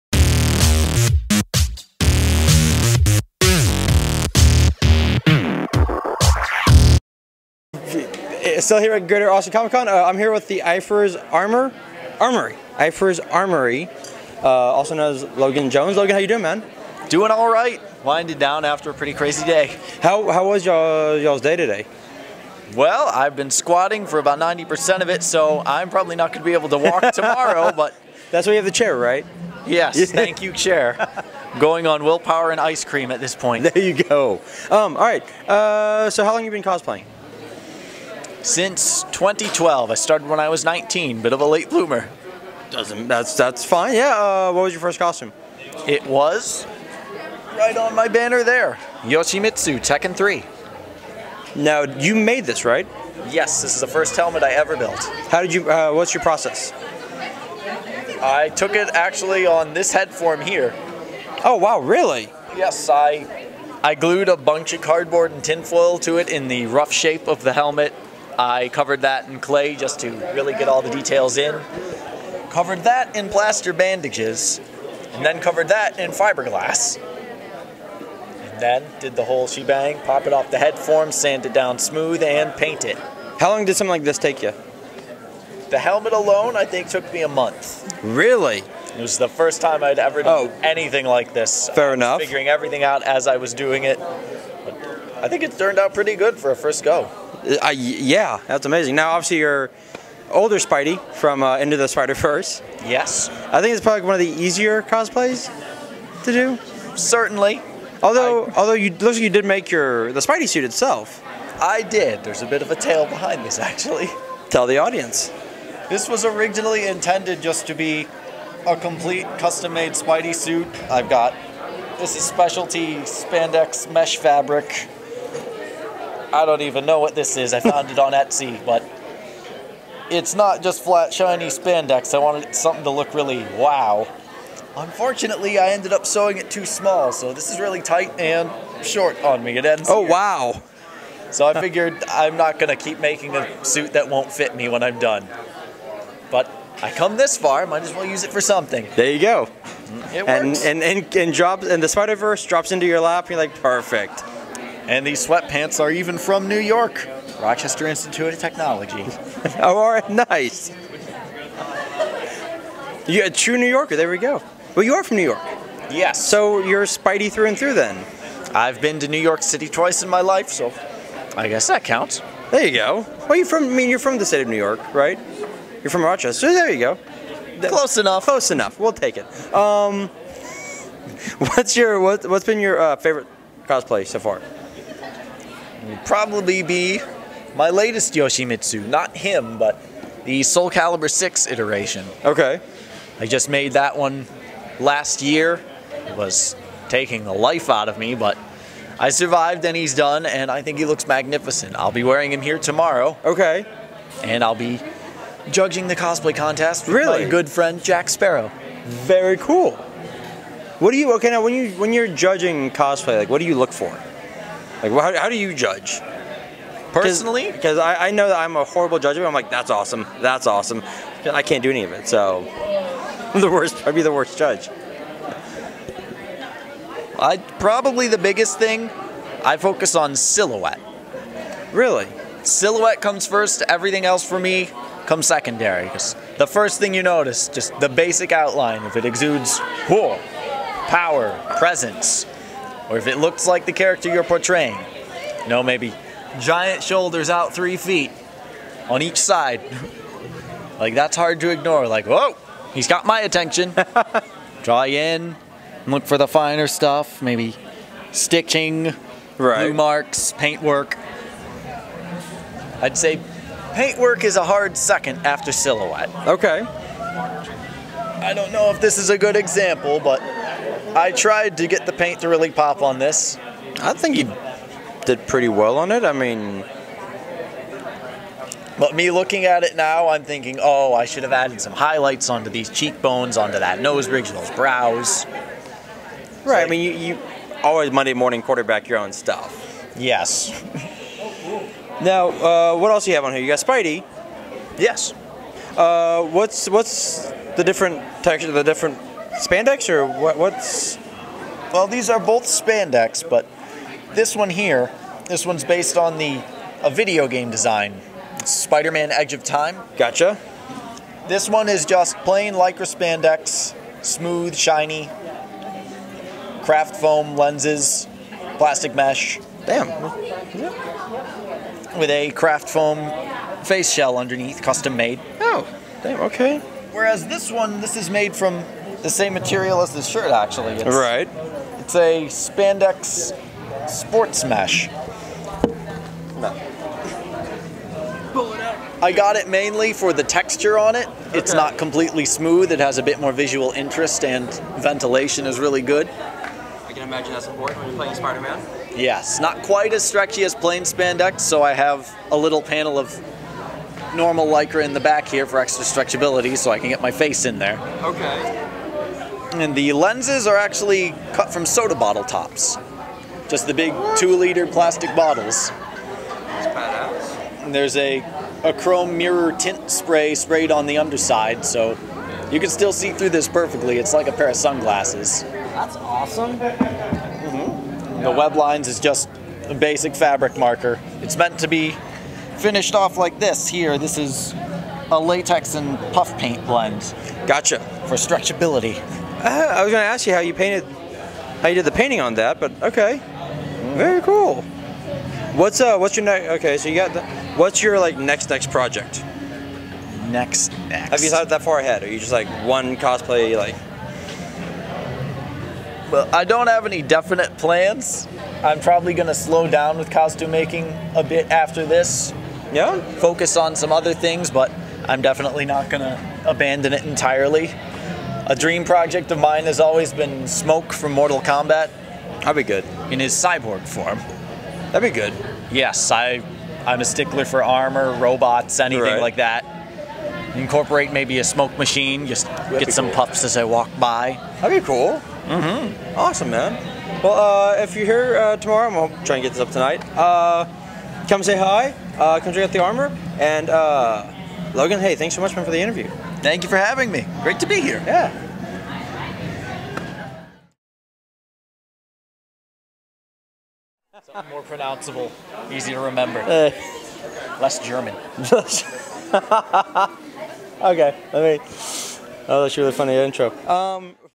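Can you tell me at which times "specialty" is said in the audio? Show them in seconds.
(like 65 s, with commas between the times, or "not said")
122 s.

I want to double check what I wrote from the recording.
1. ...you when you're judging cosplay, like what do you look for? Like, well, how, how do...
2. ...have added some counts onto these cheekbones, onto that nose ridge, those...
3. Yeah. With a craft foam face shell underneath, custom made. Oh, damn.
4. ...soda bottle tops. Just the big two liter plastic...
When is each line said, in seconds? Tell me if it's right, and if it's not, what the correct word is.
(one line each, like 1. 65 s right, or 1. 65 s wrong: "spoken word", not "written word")
1. 211 s right
2. 281 s wrong: "highlights", not "counts"
3. 319 s right
4. 361 s right.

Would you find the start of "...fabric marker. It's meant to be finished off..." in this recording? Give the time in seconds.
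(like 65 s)
380 s.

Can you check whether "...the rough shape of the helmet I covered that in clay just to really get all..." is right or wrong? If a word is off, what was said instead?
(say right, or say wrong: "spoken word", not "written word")
right.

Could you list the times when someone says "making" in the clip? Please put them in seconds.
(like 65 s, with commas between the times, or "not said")
143 s, 410 s.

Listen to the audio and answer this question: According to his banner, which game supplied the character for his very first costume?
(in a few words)
Tekken 3.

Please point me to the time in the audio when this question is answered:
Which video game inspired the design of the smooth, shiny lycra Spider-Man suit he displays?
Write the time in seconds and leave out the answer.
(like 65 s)
308 s.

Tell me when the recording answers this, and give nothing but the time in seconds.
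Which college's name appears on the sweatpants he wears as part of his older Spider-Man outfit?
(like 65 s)
157 s.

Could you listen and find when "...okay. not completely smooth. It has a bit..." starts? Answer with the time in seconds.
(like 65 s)
341 s.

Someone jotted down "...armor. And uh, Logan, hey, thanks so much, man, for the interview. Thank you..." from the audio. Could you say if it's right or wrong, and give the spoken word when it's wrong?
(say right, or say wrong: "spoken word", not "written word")
right.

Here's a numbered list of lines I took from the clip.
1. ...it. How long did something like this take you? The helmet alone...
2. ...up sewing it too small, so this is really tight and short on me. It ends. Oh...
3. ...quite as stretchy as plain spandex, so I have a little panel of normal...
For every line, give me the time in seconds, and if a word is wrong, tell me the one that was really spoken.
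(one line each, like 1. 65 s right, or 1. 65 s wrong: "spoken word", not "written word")
1. 82 s right
2. 135 s right
3. 349 s right.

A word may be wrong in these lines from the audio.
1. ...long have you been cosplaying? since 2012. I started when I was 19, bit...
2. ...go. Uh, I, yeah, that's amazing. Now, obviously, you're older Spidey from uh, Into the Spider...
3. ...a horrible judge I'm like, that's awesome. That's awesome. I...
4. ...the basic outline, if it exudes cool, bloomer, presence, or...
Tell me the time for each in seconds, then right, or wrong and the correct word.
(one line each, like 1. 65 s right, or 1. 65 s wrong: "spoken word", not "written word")
1. 36 s right
2. 96 s right
3. 218 s right
4. 237 s wrong: "power", not "bloomer".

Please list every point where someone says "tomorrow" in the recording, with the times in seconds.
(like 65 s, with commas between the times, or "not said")
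27 s, 202 s, 438 s.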